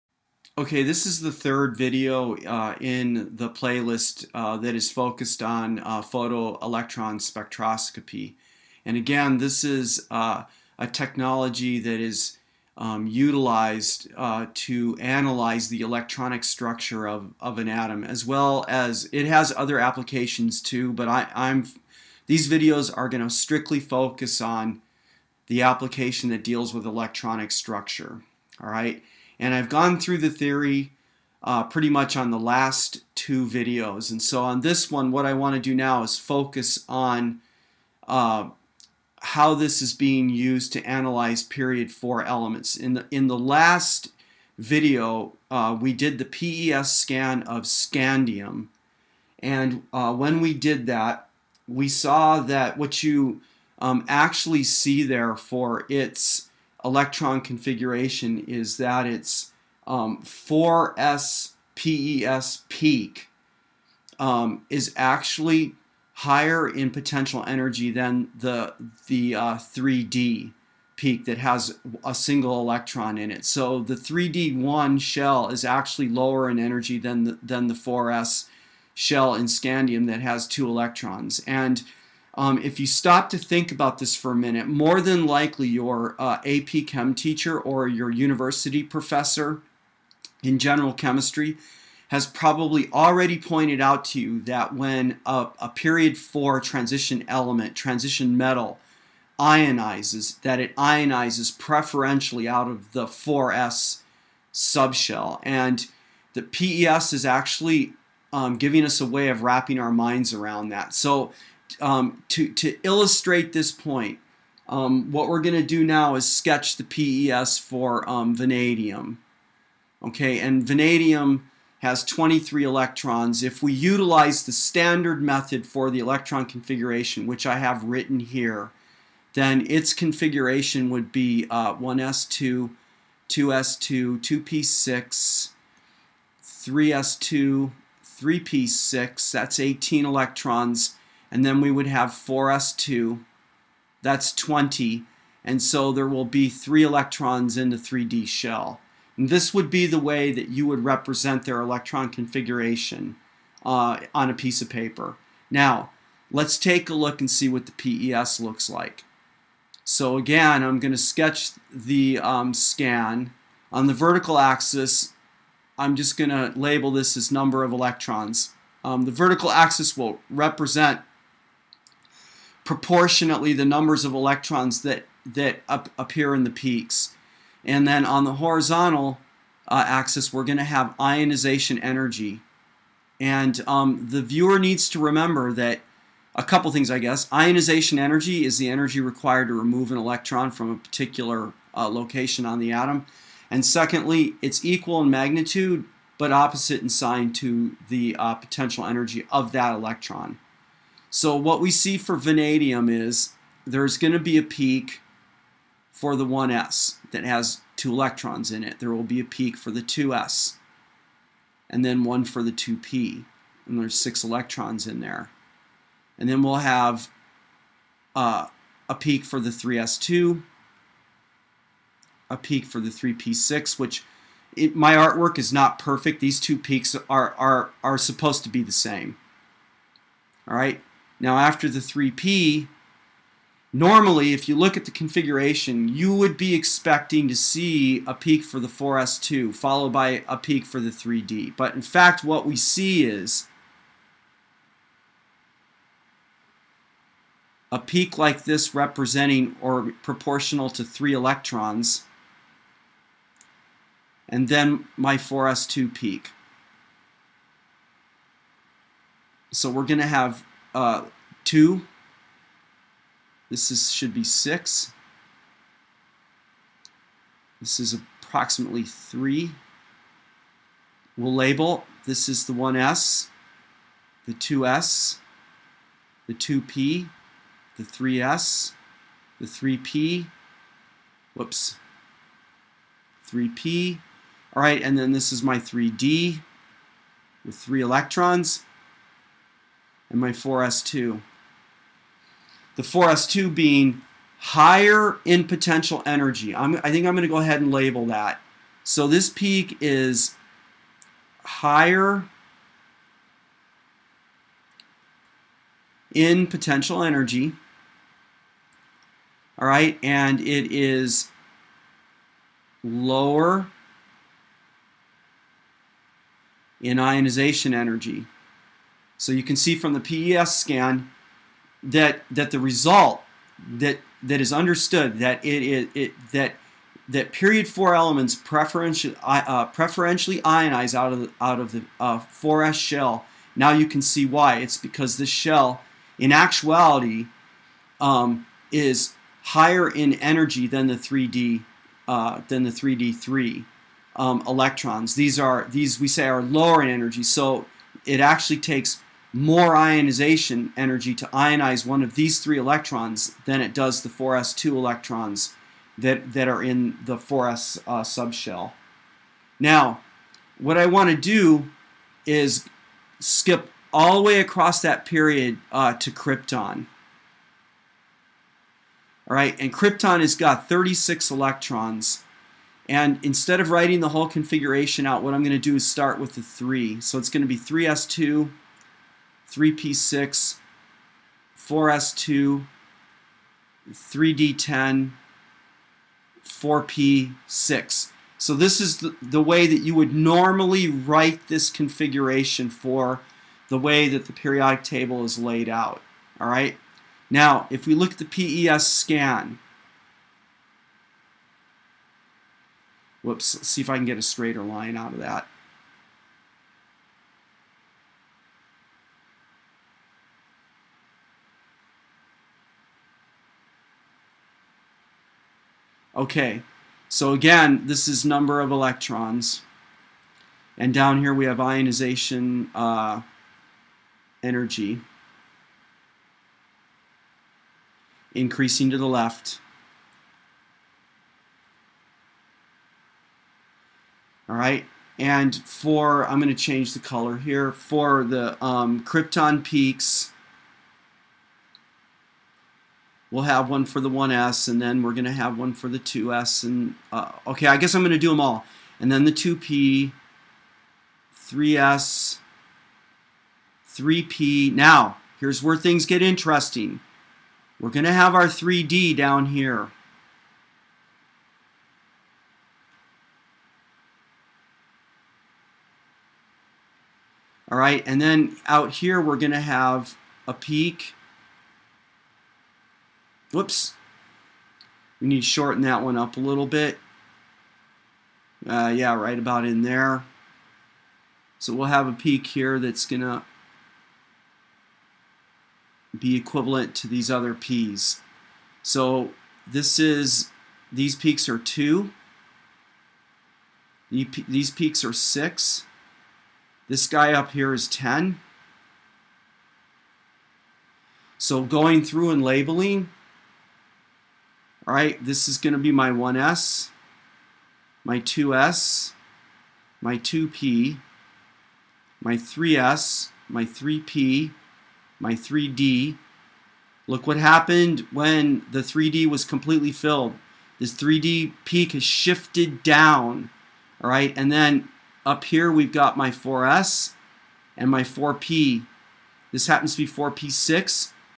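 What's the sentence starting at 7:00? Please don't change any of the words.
And down here we have ionization uh, energy increasing to the left.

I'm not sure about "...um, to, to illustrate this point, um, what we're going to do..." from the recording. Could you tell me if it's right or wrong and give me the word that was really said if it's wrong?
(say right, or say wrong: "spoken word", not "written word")
right.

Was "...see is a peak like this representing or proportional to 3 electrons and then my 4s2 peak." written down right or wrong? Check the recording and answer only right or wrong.
right.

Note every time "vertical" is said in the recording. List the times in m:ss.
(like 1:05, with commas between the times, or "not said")
2:43, 2:49.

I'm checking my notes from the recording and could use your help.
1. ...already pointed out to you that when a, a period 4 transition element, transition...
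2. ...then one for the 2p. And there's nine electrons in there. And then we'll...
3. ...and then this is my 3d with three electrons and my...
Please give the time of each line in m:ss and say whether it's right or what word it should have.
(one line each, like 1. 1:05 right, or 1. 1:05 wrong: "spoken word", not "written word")
1. 1:32 right
2. 3:31 wrong: "six", not "nine"
3. 4:44 right.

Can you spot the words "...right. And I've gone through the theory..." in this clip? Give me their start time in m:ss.
0:28.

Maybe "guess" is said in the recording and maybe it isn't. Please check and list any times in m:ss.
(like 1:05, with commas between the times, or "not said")
3:06, 7:27.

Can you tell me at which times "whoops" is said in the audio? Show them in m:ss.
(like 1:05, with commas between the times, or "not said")
4:41, 6:43, 7:53.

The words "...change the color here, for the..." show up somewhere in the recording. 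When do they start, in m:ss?
7:16.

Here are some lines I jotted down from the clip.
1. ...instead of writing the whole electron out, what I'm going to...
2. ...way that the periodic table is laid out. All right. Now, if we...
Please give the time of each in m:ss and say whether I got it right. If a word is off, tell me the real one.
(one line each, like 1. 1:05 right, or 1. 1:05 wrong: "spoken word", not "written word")
1. 6:13 wrong: "configuration", not "electron"
2. 6:33 right.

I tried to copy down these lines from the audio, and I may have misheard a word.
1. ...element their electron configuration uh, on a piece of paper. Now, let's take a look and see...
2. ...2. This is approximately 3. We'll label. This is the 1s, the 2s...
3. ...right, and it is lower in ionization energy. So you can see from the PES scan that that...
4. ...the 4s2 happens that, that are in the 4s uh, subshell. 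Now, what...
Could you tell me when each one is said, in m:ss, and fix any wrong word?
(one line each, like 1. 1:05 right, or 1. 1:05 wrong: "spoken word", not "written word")
1. 2:30 wrong: "represent", not "element"
2. 4:24 wrong: "6", not "2"
3. 5:09 right
4. 5:54 wrong: "electrons", not "happens".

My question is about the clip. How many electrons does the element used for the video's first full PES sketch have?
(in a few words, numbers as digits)
23.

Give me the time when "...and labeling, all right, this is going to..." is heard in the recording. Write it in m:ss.
8:22.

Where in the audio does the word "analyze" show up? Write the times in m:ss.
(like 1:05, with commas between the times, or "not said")
0:14, 0:40.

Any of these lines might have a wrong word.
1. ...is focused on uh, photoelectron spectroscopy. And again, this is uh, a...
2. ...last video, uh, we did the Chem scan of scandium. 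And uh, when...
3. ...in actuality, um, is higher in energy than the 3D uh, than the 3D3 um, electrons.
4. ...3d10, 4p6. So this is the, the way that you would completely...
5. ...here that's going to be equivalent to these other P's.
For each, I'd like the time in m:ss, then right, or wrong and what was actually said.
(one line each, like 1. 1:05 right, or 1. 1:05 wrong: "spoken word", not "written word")
1. 0:04 right
2. 0:43 wrong: "PES", not "Chem"
3. 5:36 right
4. 6:23 wrong: "normally", not "completely"
5. 8:02 right.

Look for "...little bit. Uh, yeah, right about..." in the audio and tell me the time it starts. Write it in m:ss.
7:56.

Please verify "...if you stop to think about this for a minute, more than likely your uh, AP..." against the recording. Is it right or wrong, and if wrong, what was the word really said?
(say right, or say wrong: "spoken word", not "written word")
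right.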